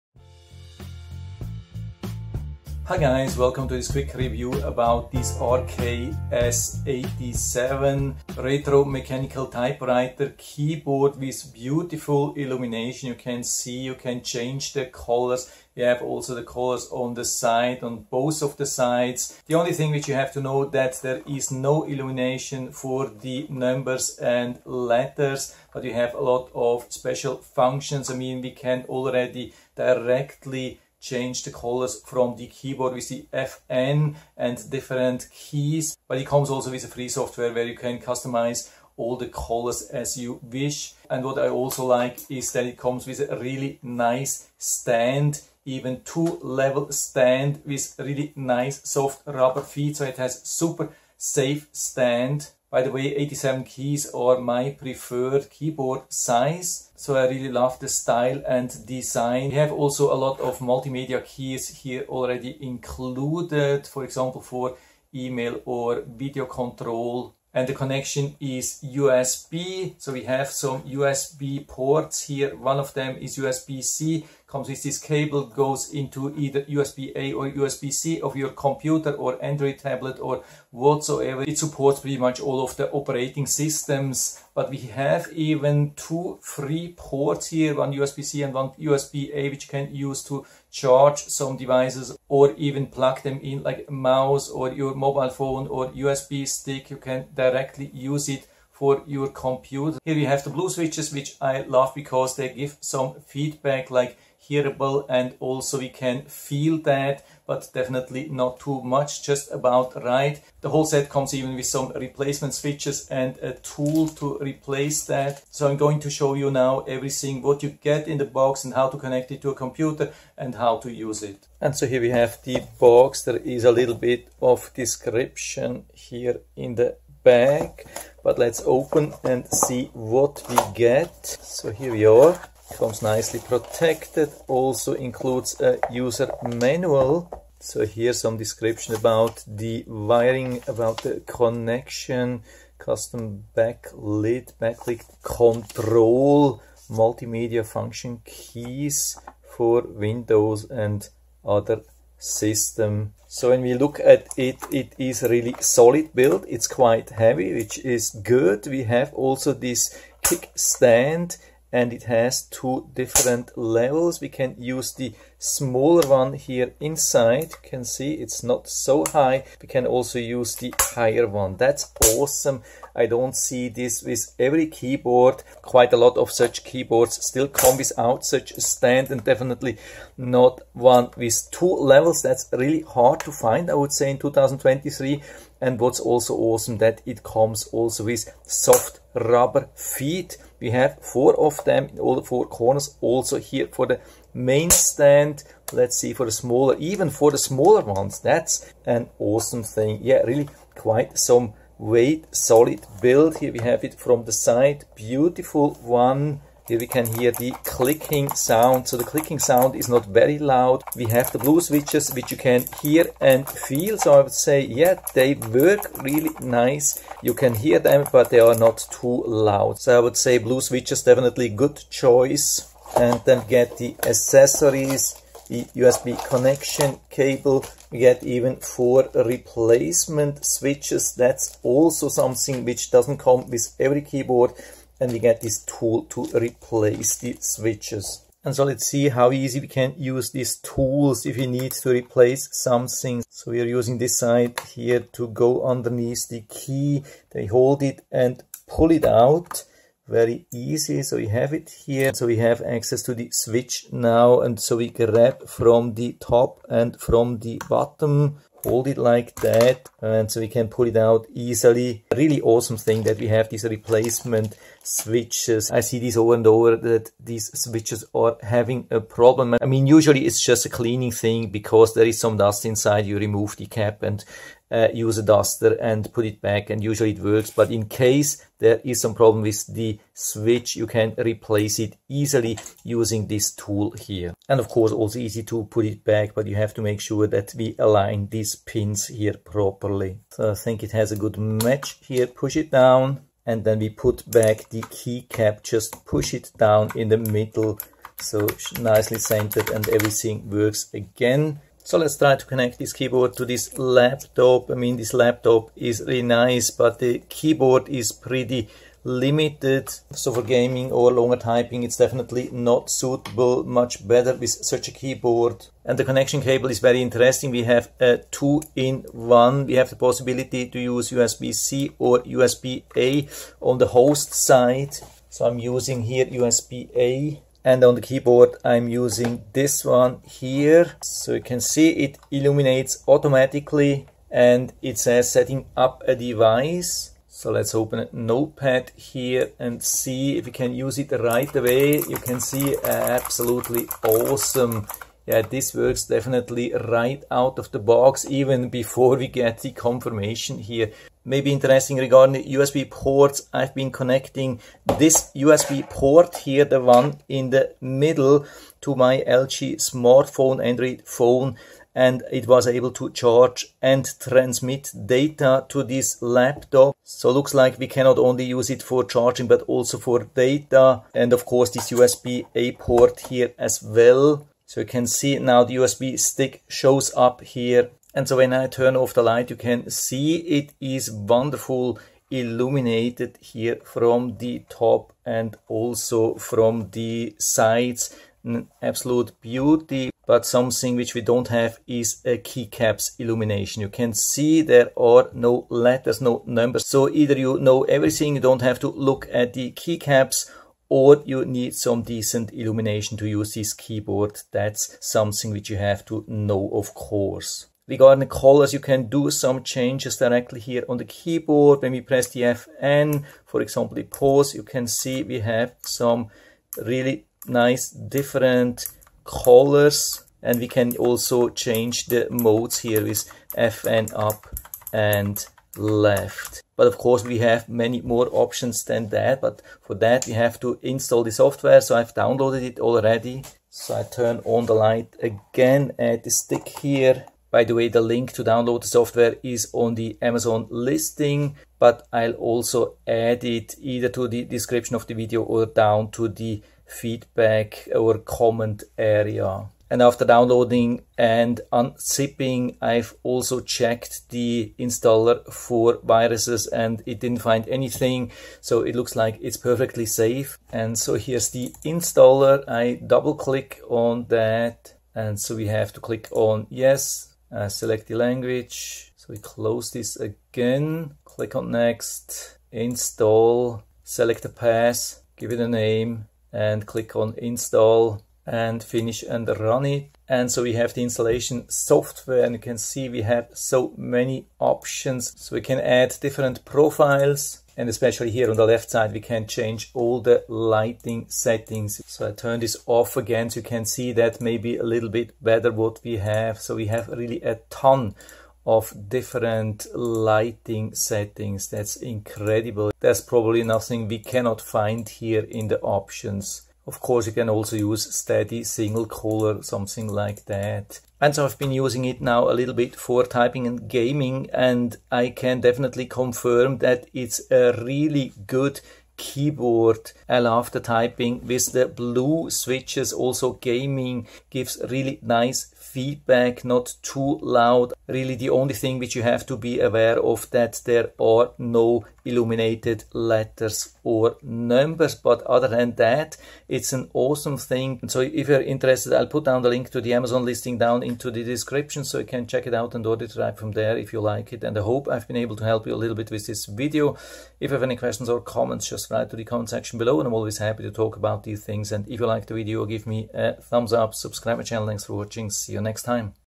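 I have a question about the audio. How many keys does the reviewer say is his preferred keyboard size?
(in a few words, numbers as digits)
87.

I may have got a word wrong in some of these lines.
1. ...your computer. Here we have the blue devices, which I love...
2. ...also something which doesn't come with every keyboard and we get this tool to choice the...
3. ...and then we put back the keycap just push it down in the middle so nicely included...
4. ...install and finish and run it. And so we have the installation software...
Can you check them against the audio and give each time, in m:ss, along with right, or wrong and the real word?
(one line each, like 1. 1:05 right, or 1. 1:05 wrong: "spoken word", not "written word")
1. 1:39 wrong: "switches", not "devices"
2. 3:51 wrong: "replace", not "choice"
3. 4:53 wrong: "centered", not "included"
4. 7:57 right.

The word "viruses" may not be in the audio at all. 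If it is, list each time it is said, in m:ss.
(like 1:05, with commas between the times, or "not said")
7:36.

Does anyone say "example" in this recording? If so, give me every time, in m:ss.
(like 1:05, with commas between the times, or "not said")
1:04, 6:53.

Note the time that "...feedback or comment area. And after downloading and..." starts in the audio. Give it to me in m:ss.
7:26.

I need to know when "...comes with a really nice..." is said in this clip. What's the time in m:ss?
0:42.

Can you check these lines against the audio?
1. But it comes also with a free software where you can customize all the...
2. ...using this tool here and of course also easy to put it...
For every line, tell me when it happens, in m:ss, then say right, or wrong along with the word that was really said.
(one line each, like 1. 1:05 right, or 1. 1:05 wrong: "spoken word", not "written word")
1. 0:36 right
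2. 4:42 right.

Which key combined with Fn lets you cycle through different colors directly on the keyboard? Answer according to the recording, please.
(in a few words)
Pause.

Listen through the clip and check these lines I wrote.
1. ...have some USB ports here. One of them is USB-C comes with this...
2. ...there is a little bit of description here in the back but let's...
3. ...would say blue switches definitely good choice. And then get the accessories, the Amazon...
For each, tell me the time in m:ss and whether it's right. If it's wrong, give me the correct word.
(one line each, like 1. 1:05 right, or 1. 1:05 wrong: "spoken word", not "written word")
1. 1:10 right
2. 2:03 right
3. 3:39 wrong: "USB", not "Amazon".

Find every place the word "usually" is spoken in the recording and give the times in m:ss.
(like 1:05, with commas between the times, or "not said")
4:29, 4:36.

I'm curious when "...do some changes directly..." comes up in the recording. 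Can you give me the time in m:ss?
6:49.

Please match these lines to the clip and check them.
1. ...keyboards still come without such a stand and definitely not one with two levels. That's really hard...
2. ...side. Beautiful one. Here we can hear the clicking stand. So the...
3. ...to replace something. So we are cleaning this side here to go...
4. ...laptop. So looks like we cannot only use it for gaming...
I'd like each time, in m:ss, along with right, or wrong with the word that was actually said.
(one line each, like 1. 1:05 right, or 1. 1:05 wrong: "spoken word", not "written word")
1. 2:56 right
2. 3:24 wrong: "sound", not "stand"
3. 4:01 wrong: "using", not "cleaning"
4. 6:06 wrong: "charging", not "gaming".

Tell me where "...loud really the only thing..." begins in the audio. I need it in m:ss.
8:47.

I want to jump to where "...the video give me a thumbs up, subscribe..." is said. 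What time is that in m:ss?
9:12.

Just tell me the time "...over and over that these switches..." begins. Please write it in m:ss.
4:26.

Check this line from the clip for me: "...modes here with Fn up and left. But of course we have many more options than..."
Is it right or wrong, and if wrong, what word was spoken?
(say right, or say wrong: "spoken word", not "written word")
right.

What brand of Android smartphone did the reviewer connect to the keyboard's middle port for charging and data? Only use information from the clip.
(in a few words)
LG.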